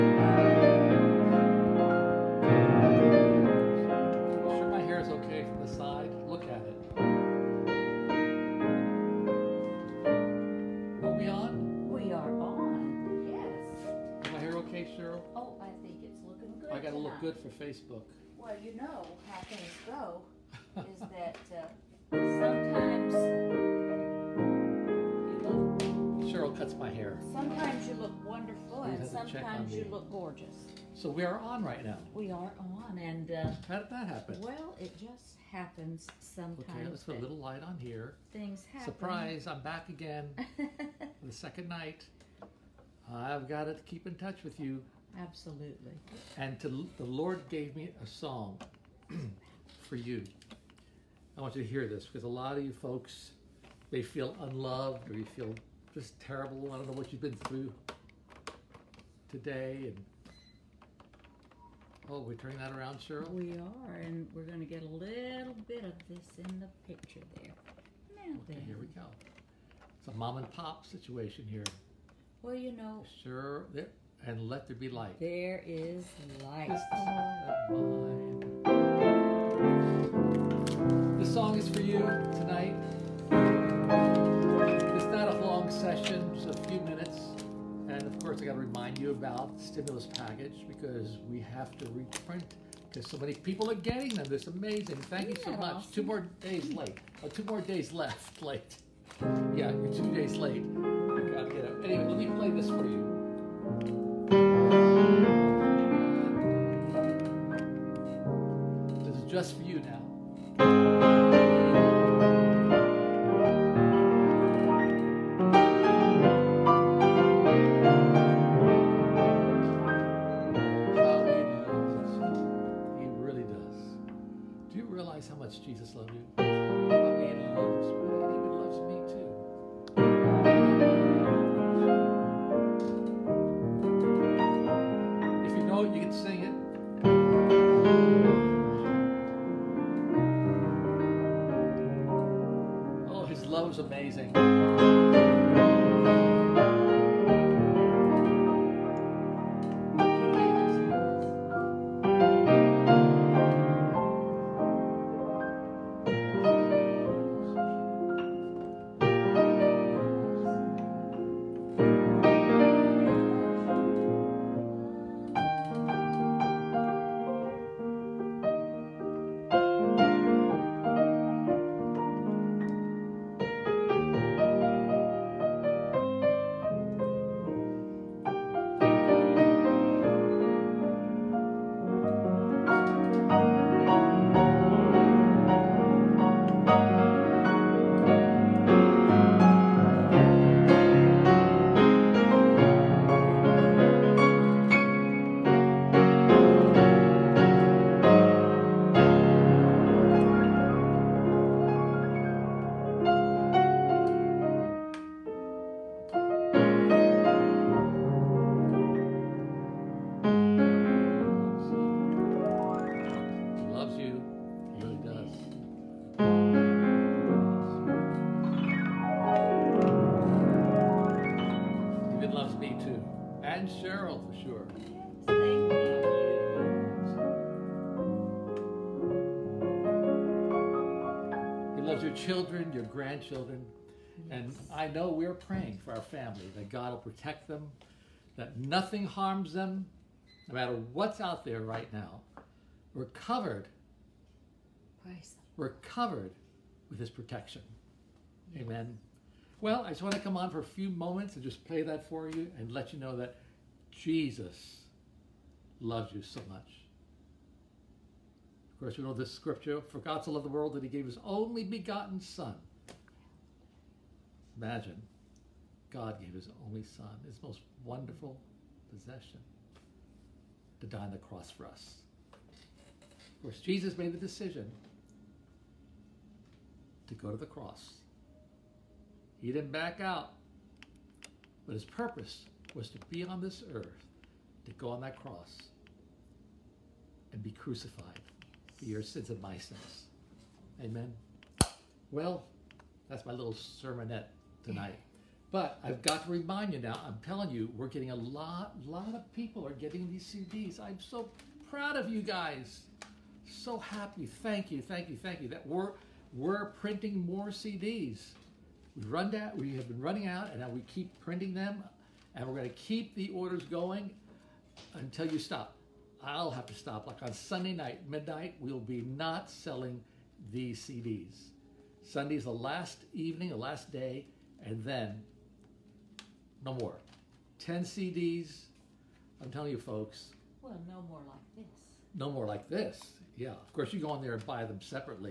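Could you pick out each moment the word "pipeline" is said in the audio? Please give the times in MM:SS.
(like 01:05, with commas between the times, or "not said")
not said.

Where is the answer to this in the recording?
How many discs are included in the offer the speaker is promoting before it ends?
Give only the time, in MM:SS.
05:27.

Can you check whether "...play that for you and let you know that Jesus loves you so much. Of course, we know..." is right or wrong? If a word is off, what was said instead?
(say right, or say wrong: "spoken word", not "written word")
right.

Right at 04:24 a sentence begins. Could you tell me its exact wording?
Imagine, God gave his only son, his most wonderful possession, to die on the cross for us.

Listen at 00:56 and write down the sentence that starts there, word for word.
I don't know what you've been through today.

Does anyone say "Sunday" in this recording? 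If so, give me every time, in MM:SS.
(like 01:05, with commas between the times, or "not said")
05:17, 05:22.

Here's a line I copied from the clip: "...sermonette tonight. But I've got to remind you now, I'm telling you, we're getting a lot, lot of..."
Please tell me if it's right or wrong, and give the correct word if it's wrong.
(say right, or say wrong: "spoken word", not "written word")
right.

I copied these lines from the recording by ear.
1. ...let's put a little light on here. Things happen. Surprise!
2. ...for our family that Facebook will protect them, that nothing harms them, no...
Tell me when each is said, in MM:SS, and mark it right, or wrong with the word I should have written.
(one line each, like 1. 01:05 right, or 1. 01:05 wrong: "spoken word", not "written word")
1. 00:36 right
2. 03:55 wrong: "God", not "Facebook".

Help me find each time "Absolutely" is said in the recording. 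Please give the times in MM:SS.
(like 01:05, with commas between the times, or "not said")
00:45.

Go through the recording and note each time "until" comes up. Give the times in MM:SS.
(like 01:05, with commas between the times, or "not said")
05:14.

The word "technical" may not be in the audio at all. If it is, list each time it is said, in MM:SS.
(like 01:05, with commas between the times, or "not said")
not said.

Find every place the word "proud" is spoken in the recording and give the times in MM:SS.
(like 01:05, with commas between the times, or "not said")
05:01.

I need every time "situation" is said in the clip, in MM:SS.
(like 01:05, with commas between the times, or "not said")
01:10.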